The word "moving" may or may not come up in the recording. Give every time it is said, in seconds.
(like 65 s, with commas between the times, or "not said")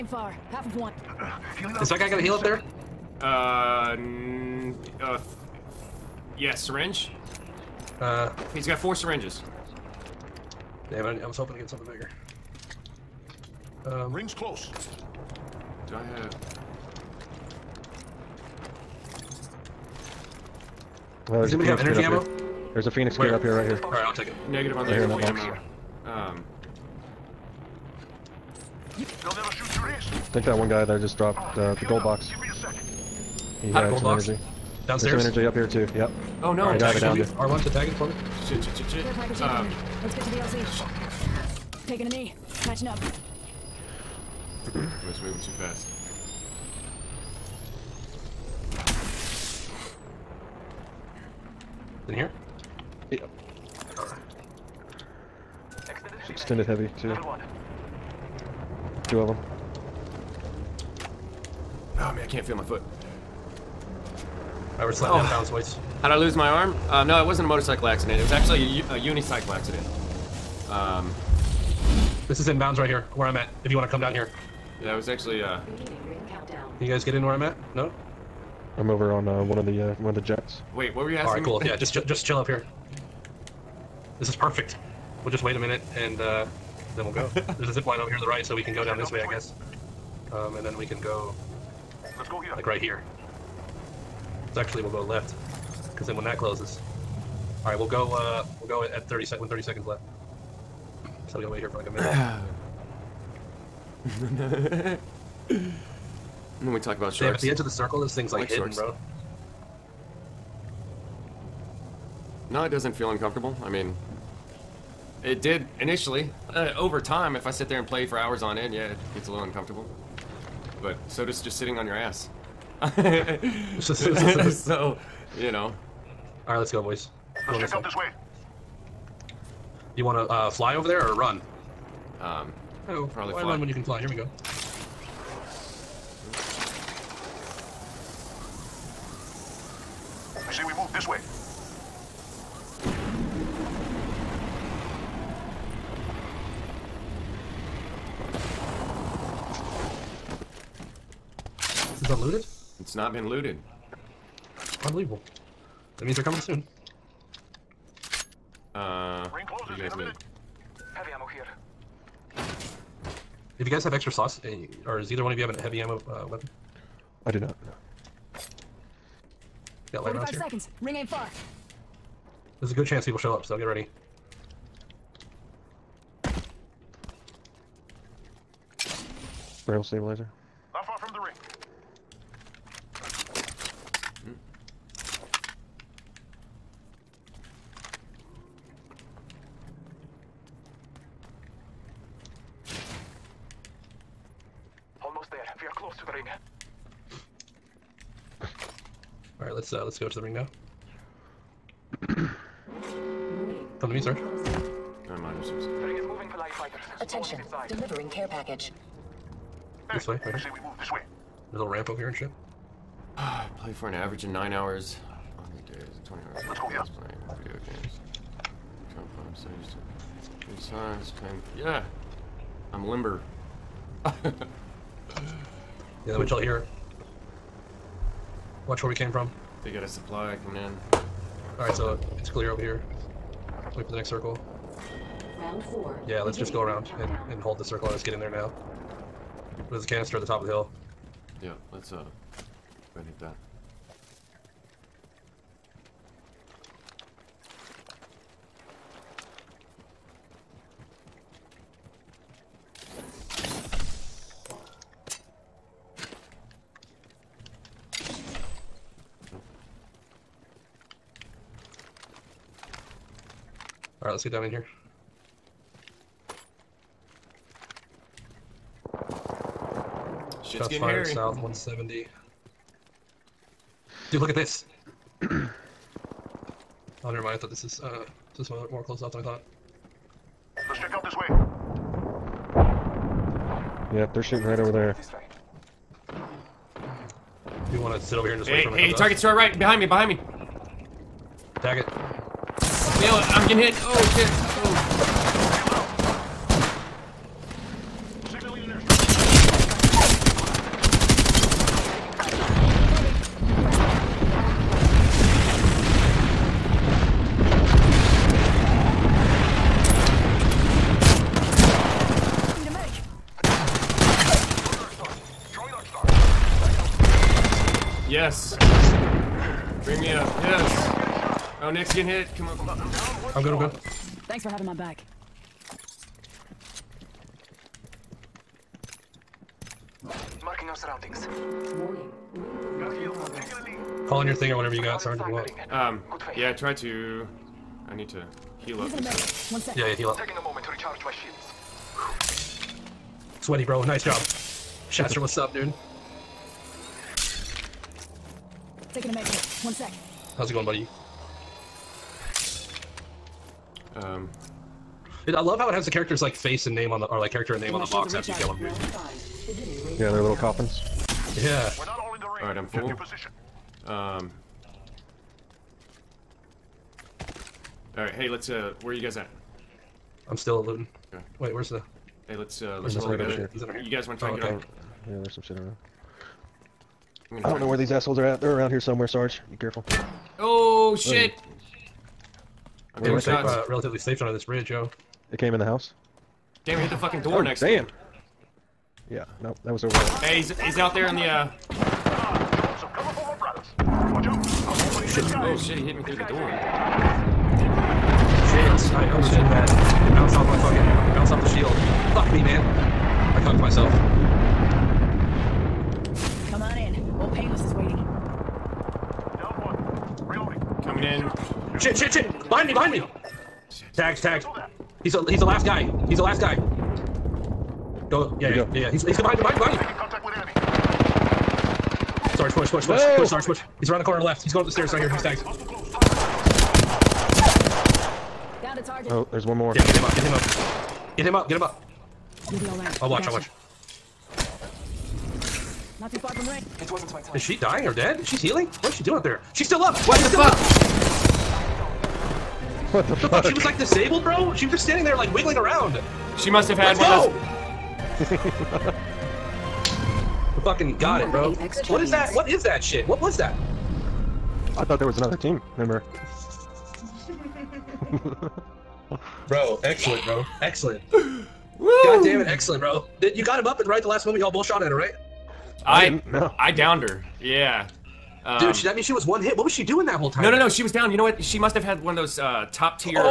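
45 s, 206 s.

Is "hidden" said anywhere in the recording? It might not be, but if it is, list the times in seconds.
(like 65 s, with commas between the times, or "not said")
108 s.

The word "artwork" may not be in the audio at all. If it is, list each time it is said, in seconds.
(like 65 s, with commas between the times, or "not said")
not said.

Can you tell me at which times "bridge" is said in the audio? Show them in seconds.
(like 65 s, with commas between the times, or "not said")
384 s.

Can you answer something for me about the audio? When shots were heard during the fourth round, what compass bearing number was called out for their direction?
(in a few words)
170.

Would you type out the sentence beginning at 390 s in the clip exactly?
Hey, he's, he's out there in the, uh...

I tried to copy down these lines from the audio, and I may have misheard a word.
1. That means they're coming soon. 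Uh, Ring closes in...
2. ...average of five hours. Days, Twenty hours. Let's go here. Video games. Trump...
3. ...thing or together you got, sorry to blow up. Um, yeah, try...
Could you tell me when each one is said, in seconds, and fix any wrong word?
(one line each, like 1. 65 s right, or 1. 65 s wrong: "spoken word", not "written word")
1. 155 s right
2. 213 s wrong: "nine", not "five"
3. 334 s wrong: "whatever", not "together".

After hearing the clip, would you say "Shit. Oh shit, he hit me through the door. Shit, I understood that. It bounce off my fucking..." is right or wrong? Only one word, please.
right.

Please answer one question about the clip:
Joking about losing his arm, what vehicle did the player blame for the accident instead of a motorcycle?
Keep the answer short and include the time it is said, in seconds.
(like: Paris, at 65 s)
unicycle, at 68 s.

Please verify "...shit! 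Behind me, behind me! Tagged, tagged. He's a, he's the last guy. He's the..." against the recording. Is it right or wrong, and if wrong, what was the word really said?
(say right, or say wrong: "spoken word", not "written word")
right.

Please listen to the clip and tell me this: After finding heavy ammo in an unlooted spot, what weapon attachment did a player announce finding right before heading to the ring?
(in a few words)
Barrel stabilizer.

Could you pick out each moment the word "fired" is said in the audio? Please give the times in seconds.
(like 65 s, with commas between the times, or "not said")
270 s.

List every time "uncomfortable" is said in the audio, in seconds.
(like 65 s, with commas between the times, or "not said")
113 s, 119 s.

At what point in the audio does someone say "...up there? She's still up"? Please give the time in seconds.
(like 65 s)
439 s.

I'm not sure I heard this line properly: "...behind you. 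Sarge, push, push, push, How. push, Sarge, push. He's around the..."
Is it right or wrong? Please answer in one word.
wrong.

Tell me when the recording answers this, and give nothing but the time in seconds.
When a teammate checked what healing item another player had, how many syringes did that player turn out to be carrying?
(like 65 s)
8 s.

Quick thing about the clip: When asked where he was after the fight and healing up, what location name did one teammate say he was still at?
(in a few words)
Luton.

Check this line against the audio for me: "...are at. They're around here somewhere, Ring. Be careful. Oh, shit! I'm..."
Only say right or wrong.
wrong.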